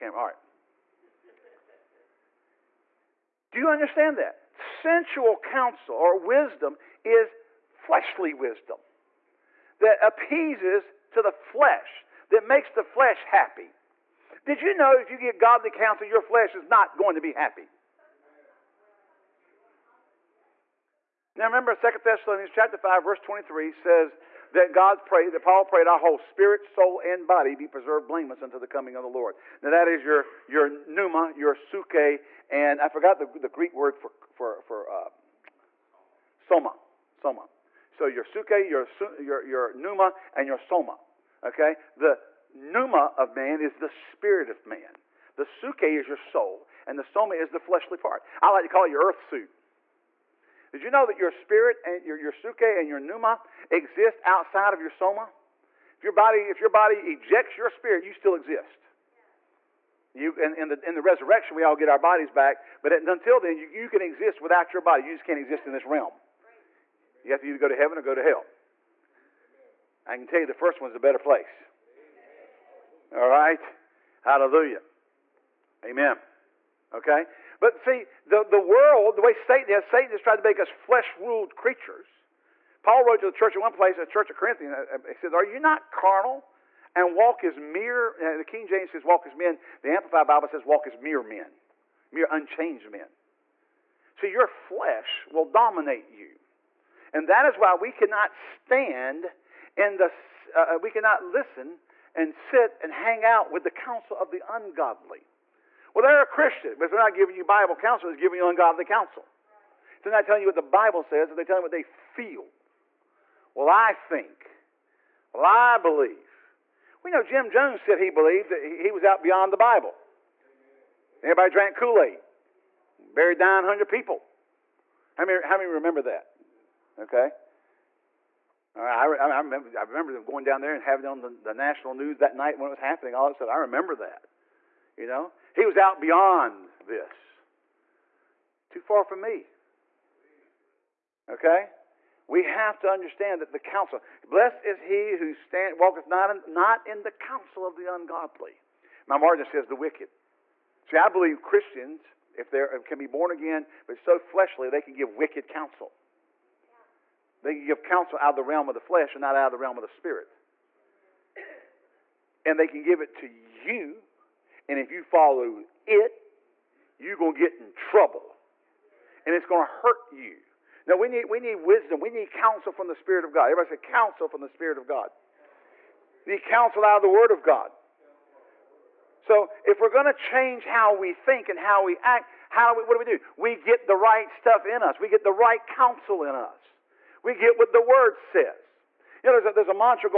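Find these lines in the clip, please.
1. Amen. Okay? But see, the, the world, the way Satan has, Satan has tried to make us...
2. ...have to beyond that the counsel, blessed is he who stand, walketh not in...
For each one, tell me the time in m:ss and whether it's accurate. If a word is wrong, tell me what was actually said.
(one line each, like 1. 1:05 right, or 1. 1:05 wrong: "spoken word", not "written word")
1. 1:15 right
2. 2:22 wrong: "understand", not "beyond".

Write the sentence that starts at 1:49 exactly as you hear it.
If they're not telling you what the Bible says, they're telling you what they feel.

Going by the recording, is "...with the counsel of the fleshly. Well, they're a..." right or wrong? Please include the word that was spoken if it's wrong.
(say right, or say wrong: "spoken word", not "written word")
wrong: "ungodly", not "fleshly".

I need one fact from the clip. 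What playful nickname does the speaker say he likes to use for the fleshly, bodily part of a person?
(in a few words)
earth suit.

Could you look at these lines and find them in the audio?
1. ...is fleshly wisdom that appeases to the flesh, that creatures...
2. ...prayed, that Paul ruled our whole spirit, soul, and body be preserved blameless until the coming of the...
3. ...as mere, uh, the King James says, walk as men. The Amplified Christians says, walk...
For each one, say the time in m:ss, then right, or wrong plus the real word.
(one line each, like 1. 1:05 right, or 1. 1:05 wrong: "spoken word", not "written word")
1. 0:07 wrong: "makes", not "creatures"
2. 0:25 wrong: "prayed", not "ruled"
3. 1:27 wrong: "Bible", not "Christians".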